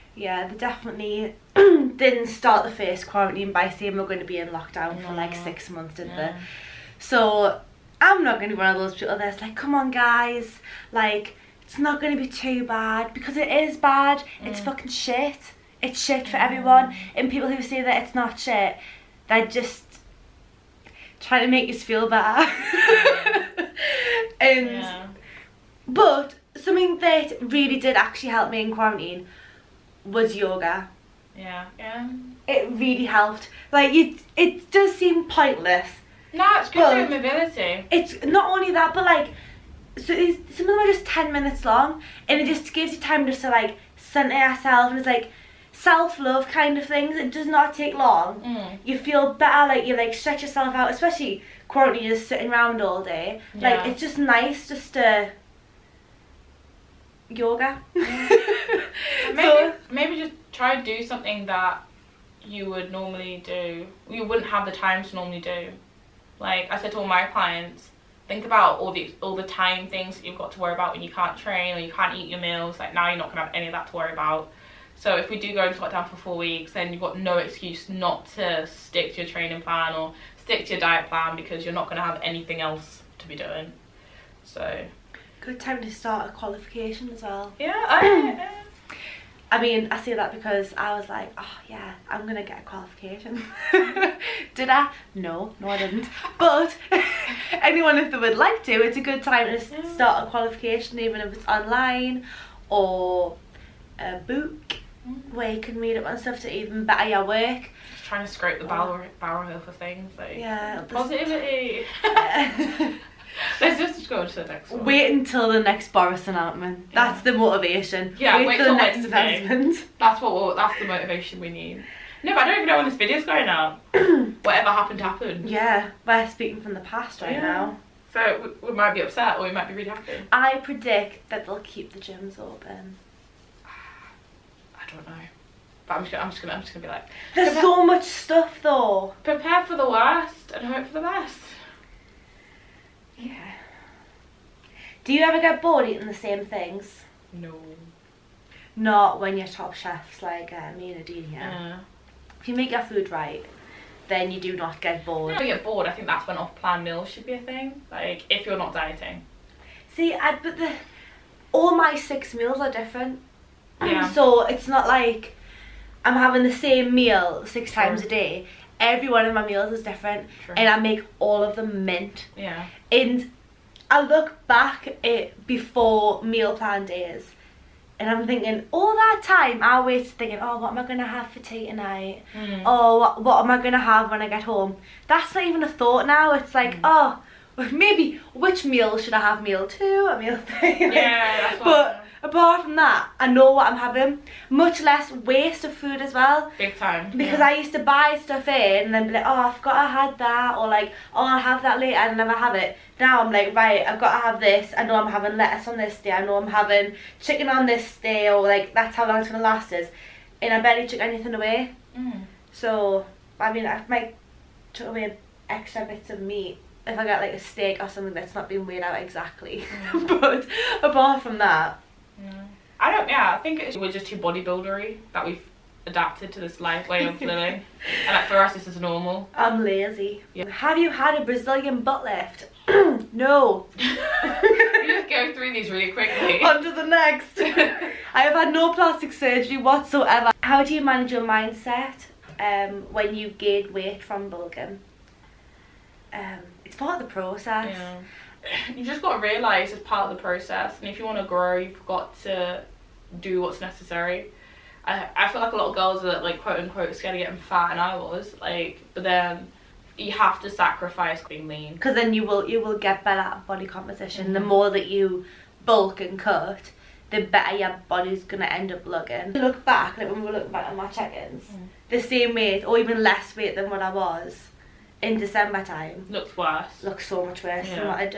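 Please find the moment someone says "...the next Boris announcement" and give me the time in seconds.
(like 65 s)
115 s.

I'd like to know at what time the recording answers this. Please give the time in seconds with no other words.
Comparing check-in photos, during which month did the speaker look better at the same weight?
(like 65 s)
275 s.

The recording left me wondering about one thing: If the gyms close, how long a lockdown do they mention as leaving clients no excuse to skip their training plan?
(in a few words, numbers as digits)
4 weeks.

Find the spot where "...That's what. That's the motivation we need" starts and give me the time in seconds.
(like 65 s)
119 s.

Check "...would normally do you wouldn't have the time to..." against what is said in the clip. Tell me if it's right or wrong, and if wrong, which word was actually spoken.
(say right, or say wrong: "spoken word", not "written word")
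right.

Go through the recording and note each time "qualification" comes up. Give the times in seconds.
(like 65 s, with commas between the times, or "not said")
86 s, 92 s, 100 s.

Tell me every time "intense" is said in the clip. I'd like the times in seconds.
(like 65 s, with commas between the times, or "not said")
not said.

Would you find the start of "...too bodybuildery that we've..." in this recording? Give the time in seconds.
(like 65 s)
224 s.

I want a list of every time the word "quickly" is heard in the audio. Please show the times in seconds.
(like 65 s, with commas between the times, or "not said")
235 s.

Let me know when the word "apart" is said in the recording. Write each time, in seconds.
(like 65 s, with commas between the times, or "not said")
192 s, 220 s.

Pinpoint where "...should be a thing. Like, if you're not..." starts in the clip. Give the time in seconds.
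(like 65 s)
157 s.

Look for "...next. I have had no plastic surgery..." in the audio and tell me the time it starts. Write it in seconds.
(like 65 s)
236 s.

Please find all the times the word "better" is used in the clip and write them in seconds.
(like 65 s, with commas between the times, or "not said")
22 s, 49 s, 106 s, 263 s, 267 s.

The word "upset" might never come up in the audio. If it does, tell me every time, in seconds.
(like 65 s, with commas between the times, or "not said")
128 s.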